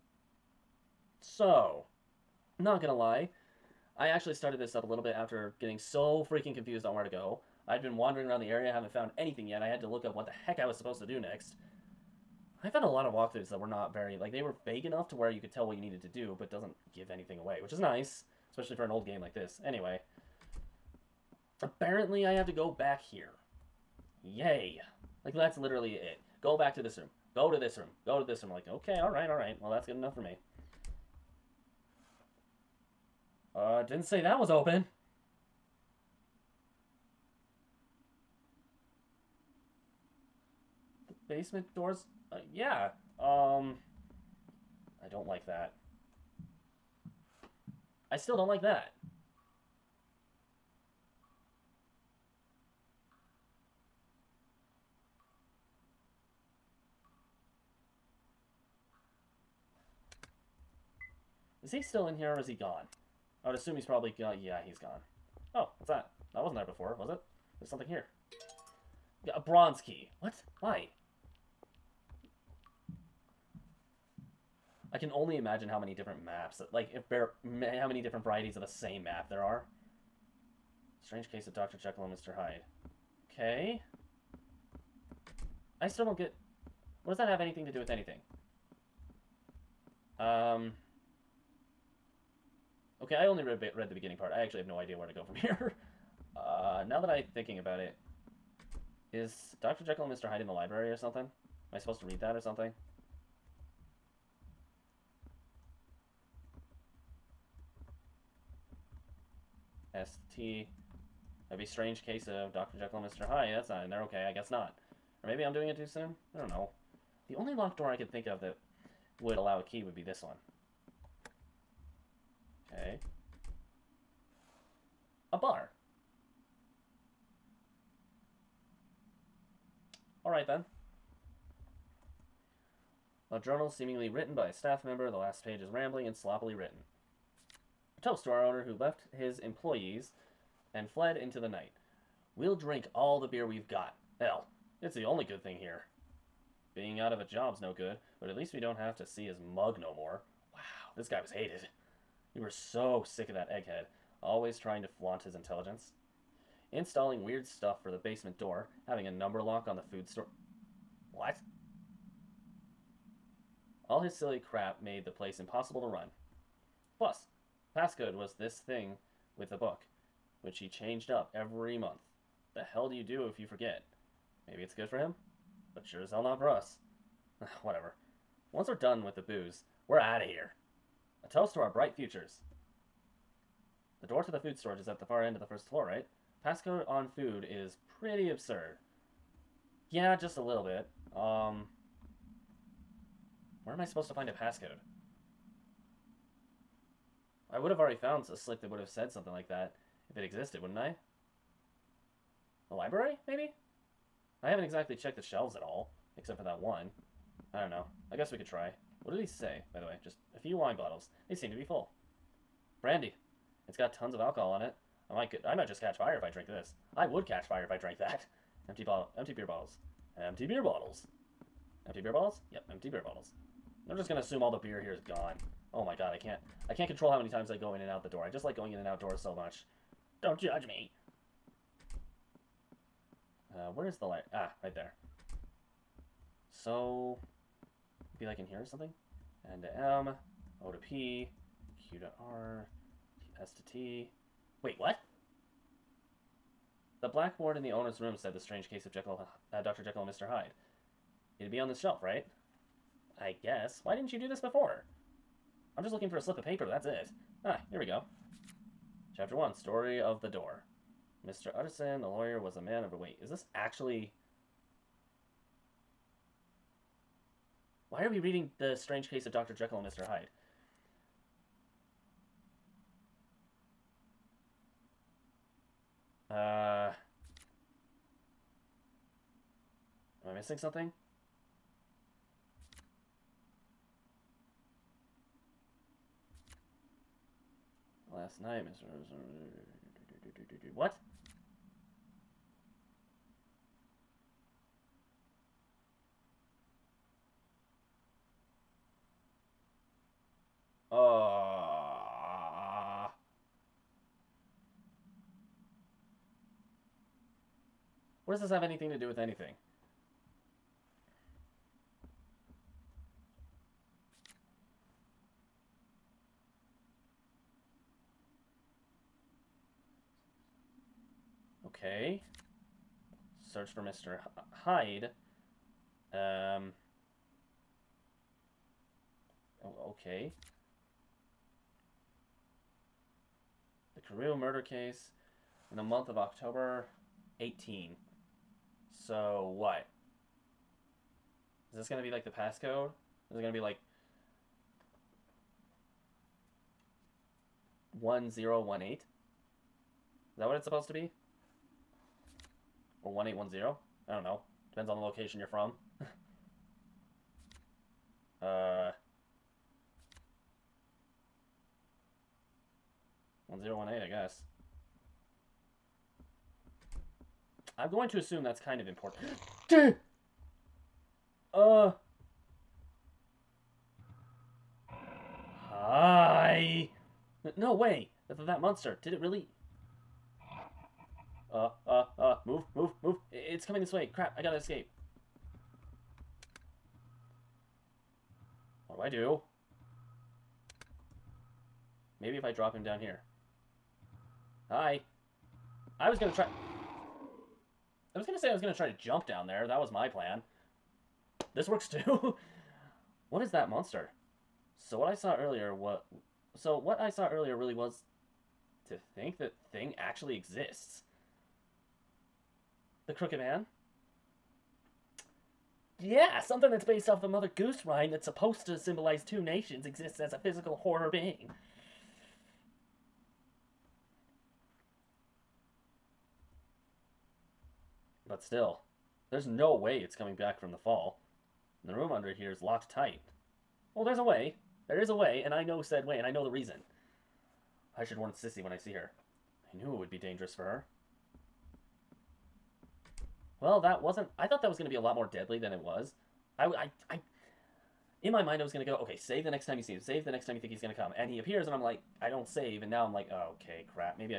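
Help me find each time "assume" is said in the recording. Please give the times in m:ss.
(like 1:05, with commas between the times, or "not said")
1:03, 3:44, 6:08.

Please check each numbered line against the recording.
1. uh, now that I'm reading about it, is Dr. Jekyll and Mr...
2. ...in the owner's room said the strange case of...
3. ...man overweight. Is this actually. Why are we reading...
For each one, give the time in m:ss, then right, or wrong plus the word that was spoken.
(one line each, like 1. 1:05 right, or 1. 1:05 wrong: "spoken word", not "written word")
1. 1:36 wrong: "thinking", not "reading"
2. 4:07 right
3. 4:22 right.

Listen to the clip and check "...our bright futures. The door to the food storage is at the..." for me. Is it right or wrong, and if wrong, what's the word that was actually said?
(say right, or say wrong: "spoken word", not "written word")
right.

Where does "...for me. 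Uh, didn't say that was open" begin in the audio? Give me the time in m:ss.
0:30.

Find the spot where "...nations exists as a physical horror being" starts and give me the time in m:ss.
6:59.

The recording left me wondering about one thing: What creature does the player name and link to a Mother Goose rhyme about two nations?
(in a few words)
The Crooked Man.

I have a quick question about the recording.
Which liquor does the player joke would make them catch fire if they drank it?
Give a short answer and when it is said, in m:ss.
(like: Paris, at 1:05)
Brandy, at 3:32.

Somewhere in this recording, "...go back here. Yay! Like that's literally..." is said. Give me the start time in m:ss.
0:22.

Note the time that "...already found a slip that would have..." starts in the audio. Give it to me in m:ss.
3:17.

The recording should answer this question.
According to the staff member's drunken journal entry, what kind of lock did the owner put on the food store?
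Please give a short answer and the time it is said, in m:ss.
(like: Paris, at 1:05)
number lock, at 2:39.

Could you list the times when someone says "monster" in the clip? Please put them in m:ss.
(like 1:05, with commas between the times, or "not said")
6:18, 6:43.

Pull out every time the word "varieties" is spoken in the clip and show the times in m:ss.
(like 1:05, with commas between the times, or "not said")
1:18.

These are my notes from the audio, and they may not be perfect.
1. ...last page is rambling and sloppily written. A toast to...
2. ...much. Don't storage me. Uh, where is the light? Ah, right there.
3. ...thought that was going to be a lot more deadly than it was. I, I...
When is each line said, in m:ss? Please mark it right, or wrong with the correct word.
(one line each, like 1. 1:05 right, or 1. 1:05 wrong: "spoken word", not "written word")
1. 2:15 right
2. 3:49 wrong: "judge", not "storage"
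3. 7:24 right.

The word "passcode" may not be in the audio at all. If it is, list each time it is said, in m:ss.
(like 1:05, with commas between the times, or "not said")
2:47, 3:06, 3:14, 5:42.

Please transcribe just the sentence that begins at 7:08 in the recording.
But still, there's no way it's coming back from the fall.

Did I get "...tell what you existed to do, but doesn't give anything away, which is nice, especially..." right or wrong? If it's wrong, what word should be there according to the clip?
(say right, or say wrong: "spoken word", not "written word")
wrong: "needed", not "existed".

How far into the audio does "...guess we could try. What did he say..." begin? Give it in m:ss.
3:28.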